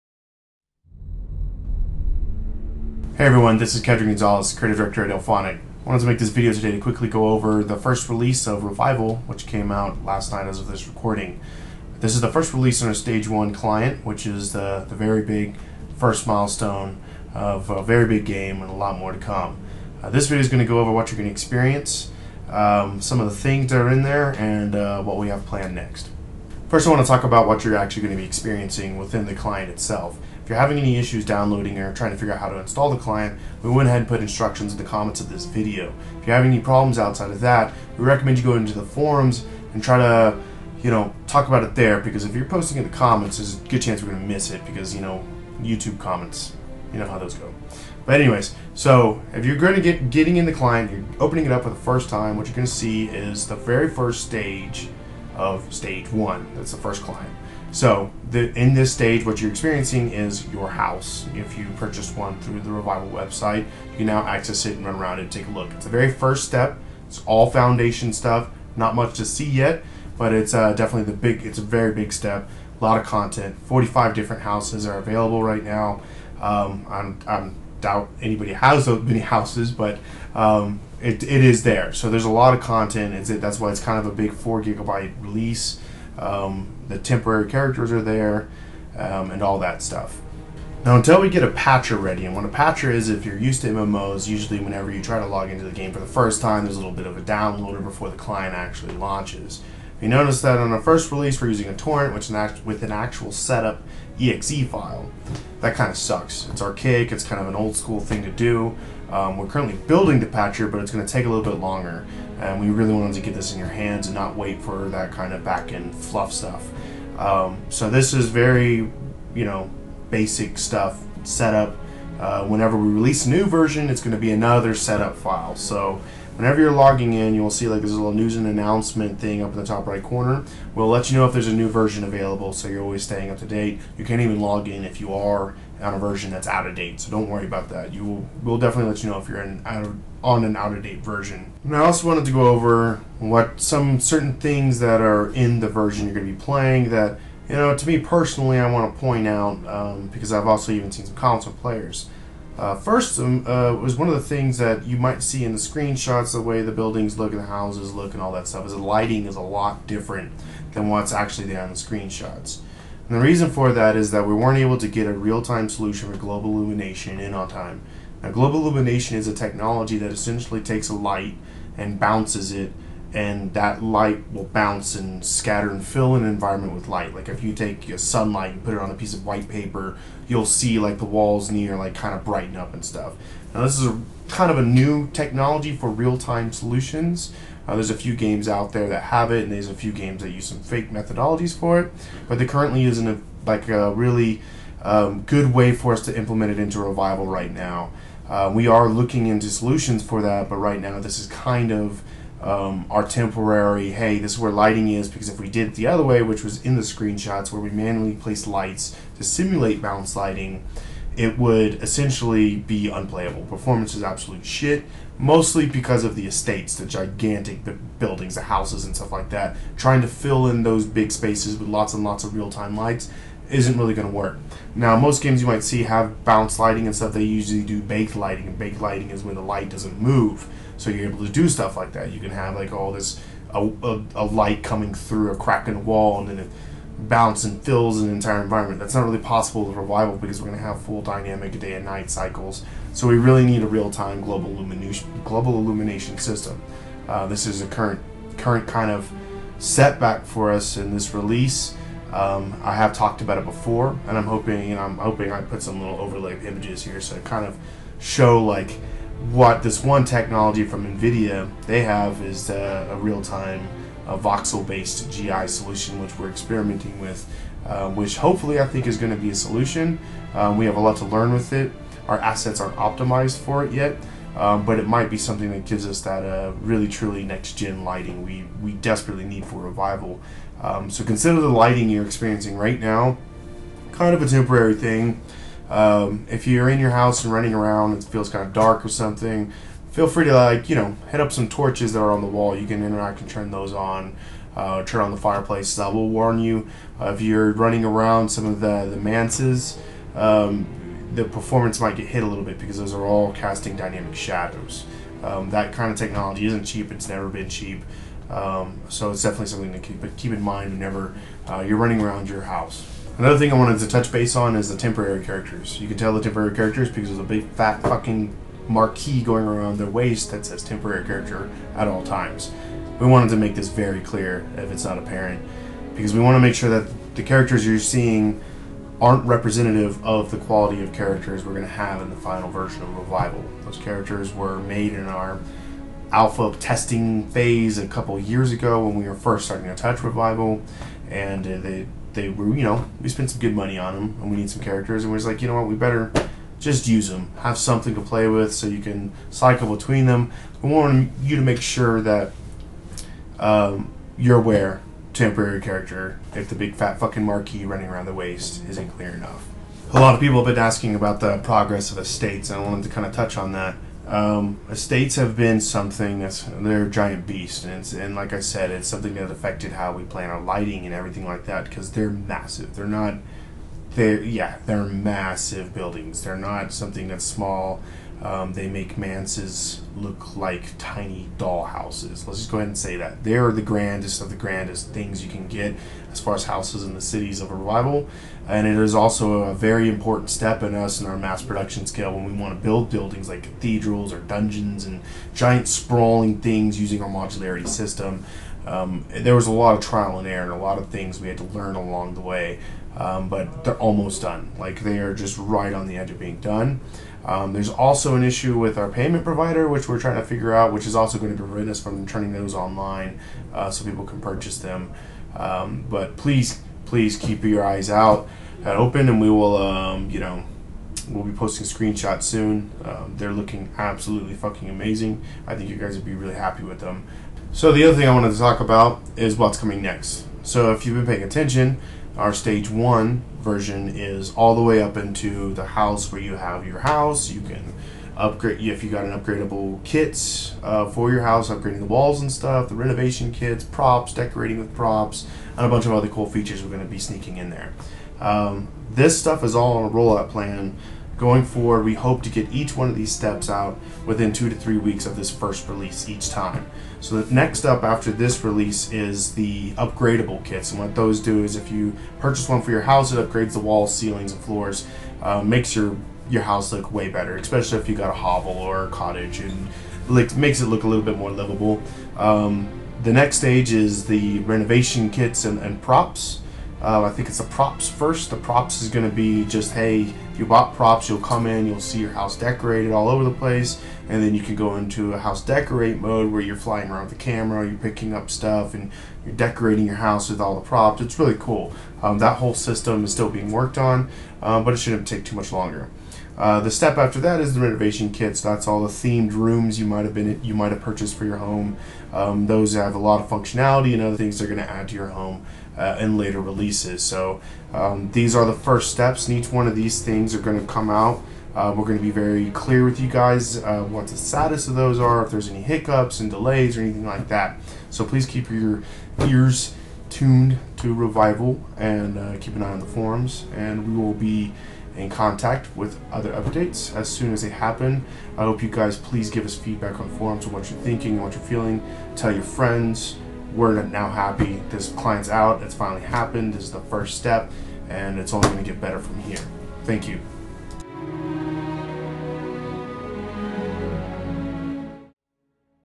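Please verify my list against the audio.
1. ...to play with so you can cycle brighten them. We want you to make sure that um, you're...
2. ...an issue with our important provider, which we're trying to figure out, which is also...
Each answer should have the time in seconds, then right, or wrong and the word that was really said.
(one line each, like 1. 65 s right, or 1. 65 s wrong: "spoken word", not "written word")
1. 347 s wrong: "between", not "brighten"
2. 408 s wrong: "payment", not "important".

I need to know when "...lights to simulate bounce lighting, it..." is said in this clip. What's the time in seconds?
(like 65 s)
208 s.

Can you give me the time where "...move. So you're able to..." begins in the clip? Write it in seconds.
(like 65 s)
230 s.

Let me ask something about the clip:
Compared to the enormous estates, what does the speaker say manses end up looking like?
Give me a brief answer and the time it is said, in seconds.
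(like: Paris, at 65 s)
Tiny dollhouses, at 380 s.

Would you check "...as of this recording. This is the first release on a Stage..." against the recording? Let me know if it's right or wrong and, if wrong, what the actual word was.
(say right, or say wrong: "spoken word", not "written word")
right.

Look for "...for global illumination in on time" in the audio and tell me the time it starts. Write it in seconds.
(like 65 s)
166 s.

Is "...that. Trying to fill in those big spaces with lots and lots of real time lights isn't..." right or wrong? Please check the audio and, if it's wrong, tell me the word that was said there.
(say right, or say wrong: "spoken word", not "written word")
right.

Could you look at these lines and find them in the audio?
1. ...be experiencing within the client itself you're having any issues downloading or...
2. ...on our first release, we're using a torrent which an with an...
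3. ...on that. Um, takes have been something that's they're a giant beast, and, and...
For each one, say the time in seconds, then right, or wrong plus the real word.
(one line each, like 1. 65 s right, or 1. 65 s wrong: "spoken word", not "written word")
1. 28 s right
2. 100 s right
3. 363 s wrong: "estates", not "takes".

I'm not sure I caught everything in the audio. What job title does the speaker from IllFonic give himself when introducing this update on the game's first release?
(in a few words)
Creative Director.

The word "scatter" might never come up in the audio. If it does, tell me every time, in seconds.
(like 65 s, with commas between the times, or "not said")
175 s.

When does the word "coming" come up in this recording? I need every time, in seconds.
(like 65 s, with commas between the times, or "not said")
234 s, 429 s.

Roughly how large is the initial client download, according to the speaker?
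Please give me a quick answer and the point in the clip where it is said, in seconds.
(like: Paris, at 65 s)
4 gigabytes, at 84 s.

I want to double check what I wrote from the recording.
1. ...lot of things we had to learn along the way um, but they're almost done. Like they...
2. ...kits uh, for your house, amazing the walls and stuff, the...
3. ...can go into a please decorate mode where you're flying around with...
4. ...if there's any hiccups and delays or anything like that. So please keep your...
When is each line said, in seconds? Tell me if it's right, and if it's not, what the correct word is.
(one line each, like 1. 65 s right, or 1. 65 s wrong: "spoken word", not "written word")
1. 400 s right
2. 439 s wrong: "upgrading", not "amazing"
3. 484 s wrong: "house", not "please"
4. 515 s right.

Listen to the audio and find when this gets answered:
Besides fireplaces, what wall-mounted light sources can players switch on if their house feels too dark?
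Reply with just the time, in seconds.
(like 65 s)
291 s.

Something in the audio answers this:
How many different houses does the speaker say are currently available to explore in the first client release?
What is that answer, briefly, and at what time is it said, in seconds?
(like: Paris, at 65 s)
45, at 73 s.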